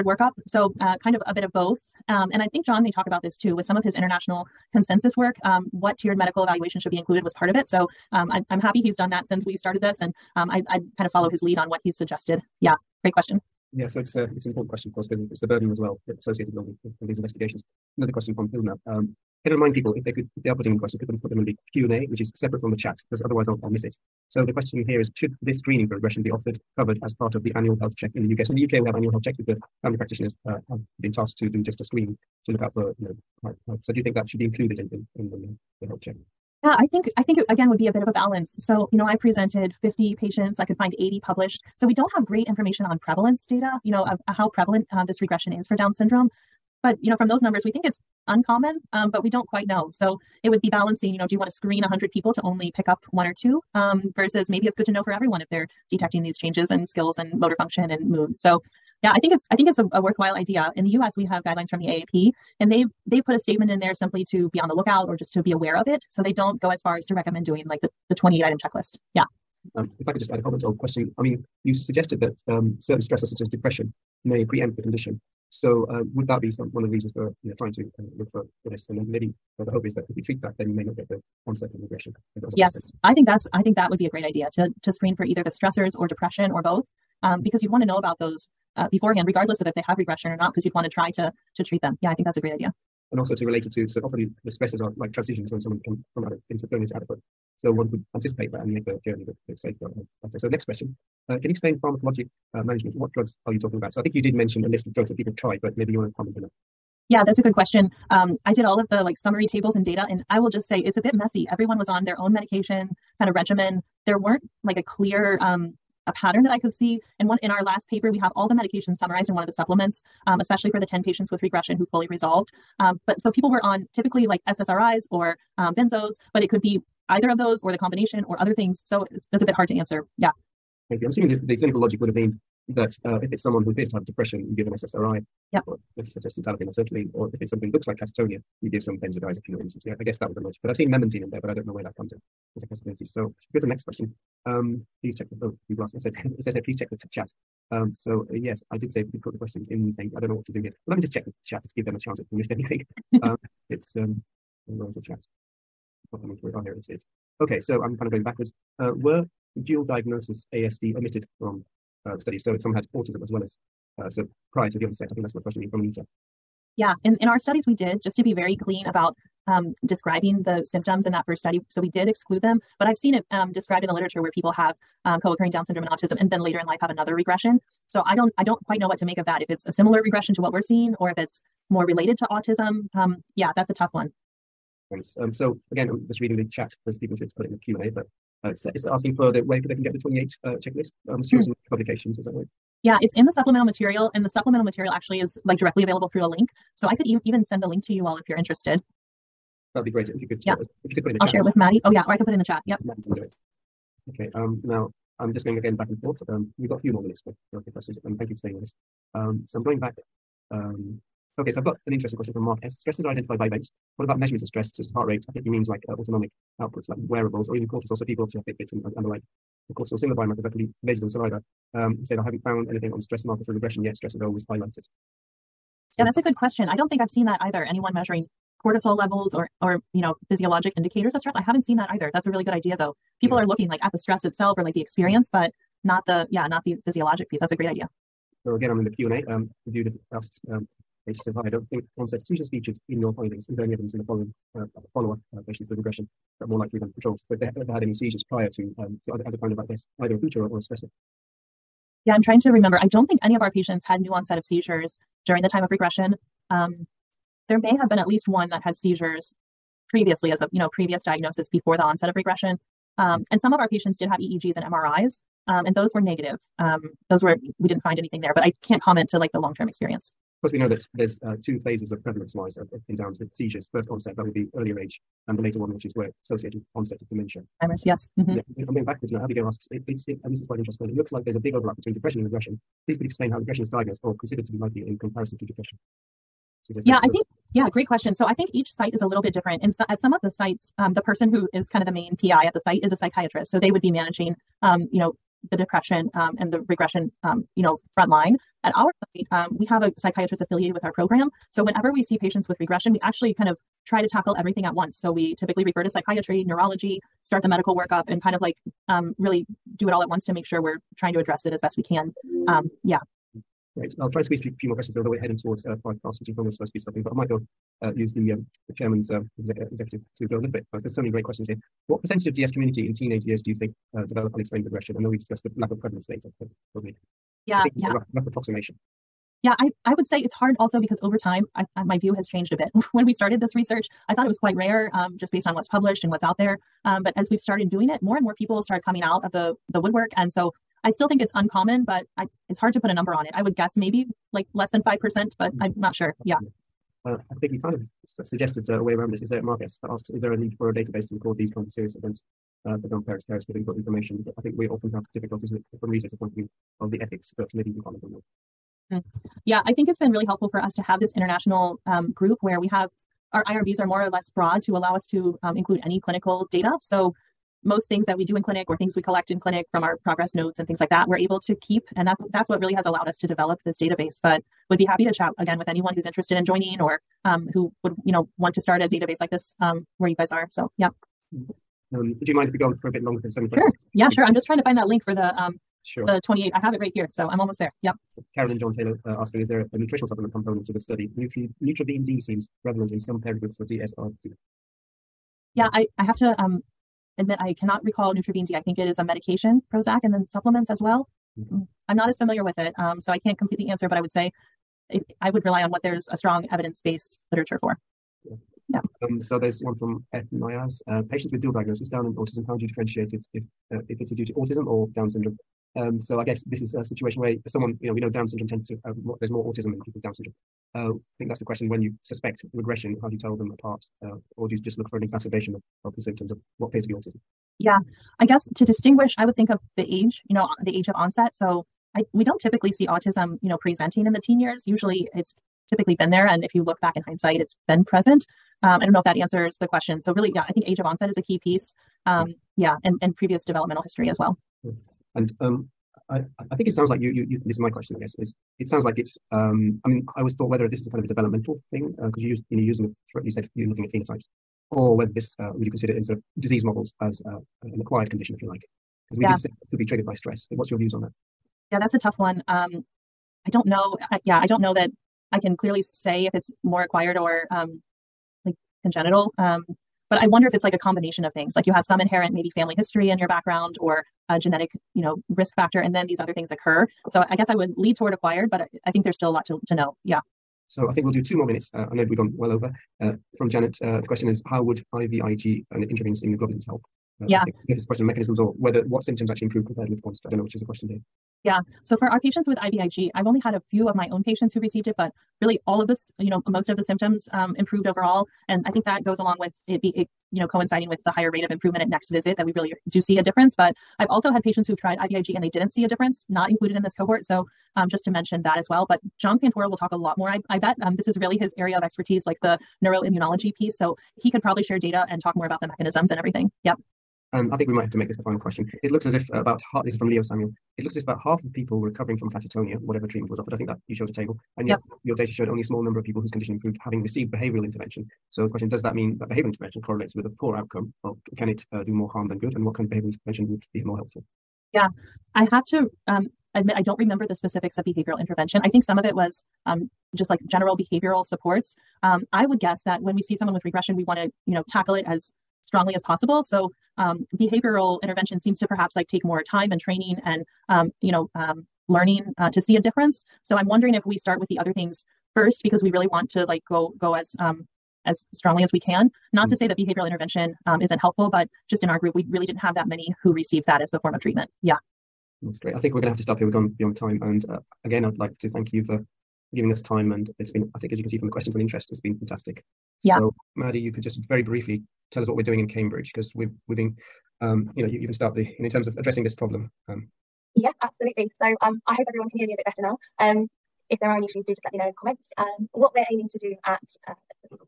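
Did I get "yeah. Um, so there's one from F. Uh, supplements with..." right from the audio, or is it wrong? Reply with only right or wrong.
wrong.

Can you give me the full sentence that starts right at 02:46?
Yeah, in, in our studies we did, just to be very clean about um, describing the symptoms in that first study.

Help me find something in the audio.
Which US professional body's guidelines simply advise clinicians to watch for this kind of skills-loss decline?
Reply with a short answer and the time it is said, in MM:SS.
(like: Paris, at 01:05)
AAP, at 01:01.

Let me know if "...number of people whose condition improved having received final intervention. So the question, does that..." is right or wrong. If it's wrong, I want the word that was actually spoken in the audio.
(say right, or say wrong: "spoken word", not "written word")
wrong: "behavioral", not "final".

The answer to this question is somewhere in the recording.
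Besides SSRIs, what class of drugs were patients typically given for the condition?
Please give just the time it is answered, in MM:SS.
02:05.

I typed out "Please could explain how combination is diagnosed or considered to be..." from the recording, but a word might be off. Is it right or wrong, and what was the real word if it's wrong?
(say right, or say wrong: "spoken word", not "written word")
wrong: "regression", not "combination".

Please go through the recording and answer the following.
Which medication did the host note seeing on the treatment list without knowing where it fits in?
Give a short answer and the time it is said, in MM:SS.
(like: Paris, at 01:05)
Memantine, at 02:20.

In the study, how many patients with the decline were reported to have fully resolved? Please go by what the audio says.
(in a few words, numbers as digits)
10.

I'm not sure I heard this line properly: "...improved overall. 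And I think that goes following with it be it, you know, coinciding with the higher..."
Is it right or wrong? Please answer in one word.
wrong.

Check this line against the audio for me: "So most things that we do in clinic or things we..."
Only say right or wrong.
right.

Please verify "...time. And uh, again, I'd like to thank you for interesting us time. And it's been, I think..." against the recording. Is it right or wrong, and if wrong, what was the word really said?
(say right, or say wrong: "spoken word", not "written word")
wrong: "giving", not "interesting".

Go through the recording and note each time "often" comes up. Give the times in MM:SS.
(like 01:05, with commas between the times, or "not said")
01:34, 05:54.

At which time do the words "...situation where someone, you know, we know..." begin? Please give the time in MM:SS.
06:56.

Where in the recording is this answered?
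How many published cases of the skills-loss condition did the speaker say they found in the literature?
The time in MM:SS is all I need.
00:40.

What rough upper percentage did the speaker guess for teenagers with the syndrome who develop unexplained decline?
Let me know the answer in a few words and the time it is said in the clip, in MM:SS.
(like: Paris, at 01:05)
5%, at 05:44.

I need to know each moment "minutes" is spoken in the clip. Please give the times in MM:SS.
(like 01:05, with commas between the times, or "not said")
03:27, 08:01.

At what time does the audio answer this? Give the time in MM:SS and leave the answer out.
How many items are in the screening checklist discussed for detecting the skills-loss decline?
01:08.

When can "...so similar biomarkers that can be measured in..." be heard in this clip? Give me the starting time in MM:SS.
03:39.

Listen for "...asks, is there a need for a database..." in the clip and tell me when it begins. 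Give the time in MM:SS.
05:49.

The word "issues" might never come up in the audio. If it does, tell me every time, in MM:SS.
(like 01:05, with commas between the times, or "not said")
09:44.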